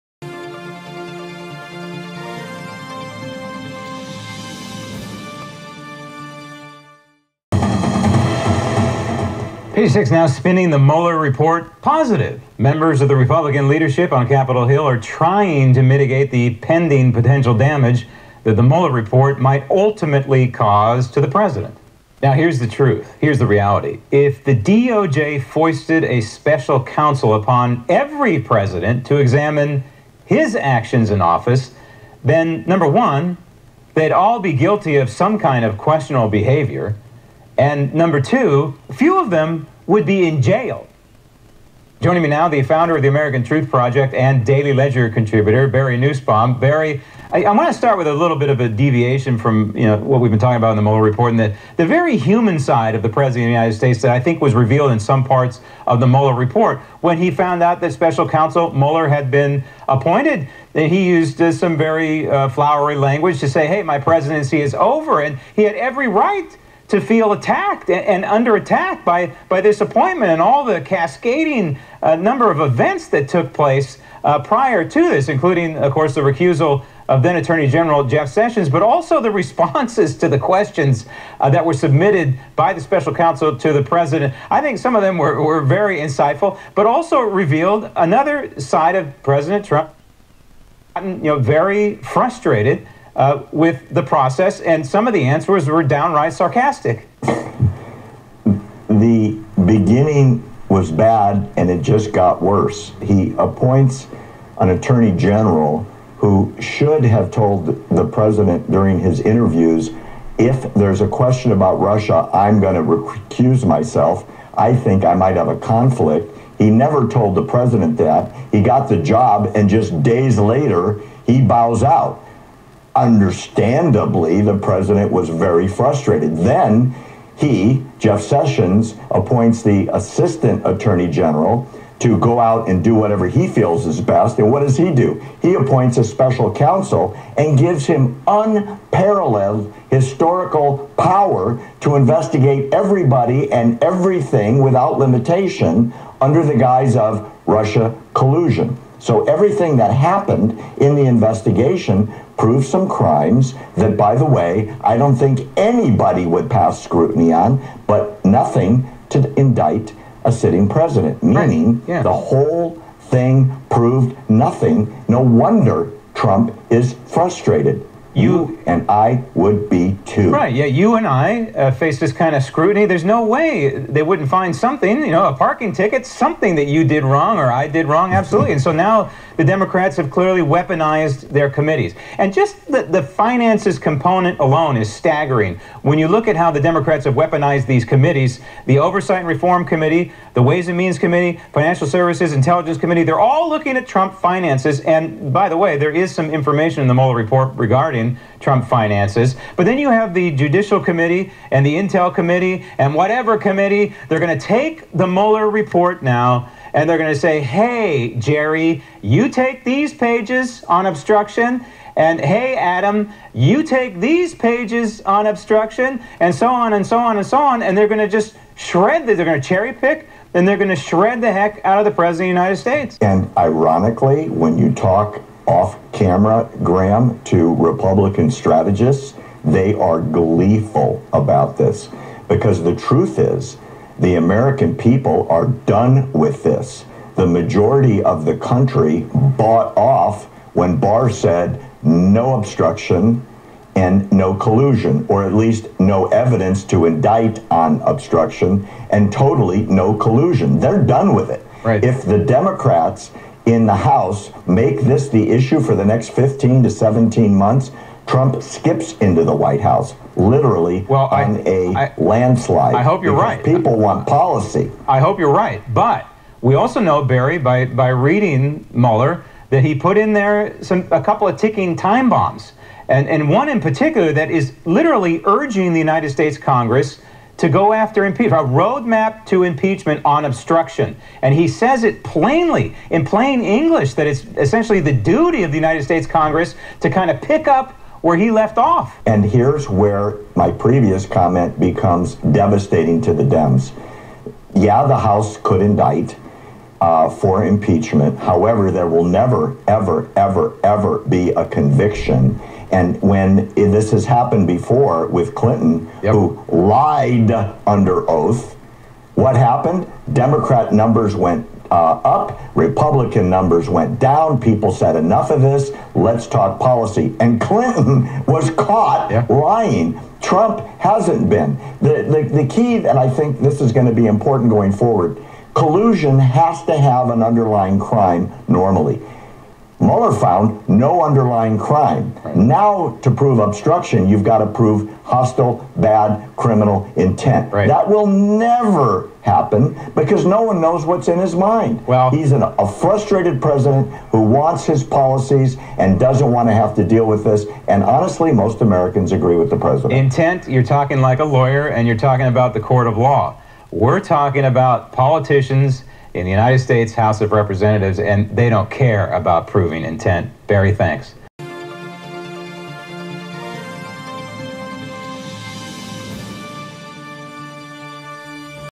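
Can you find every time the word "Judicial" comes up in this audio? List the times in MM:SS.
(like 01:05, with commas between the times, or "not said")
03:20.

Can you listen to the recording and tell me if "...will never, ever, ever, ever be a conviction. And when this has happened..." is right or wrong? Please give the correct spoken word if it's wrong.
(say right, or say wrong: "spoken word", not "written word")
right.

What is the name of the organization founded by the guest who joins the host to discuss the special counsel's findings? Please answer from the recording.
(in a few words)
American Truth Project.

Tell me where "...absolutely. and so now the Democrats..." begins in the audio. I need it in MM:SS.
02:58.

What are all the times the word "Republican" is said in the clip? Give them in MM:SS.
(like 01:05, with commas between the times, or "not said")
00:13, 03:47, 05:12.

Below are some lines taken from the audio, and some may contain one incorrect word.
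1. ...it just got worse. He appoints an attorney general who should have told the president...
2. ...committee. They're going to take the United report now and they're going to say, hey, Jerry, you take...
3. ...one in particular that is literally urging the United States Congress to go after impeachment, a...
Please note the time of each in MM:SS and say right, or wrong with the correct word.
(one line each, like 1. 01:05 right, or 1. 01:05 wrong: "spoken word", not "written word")
1. 01:41 right
2. 03:23 wrong: "Mueller", not "United"
3. 04:33 right.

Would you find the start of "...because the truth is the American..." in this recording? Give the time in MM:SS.
03:52.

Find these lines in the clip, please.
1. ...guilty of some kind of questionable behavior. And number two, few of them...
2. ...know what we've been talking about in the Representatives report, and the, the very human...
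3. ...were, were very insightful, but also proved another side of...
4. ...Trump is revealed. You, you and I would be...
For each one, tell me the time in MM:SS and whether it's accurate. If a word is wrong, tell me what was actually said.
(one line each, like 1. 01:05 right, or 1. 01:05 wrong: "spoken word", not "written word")
1. 00:34 right
2. 00:49 wrong: "Mueller", not "Representatives"
3. 01:25 wrong: "revealed", not "proved"
4. 02:46 wrong: "frustrated", not "revealed".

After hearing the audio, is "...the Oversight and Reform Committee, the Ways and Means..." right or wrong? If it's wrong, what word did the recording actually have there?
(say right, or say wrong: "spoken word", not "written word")
right.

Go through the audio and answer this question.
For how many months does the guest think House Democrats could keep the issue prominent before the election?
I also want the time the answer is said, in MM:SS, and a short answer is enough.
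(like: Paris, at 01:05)
15 to 17 months, at 04:16.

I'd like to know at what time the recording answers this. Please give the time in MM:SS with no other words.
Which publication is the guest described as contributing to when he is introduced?
00:44.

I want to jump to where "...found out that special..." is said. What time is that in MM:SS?
00:57.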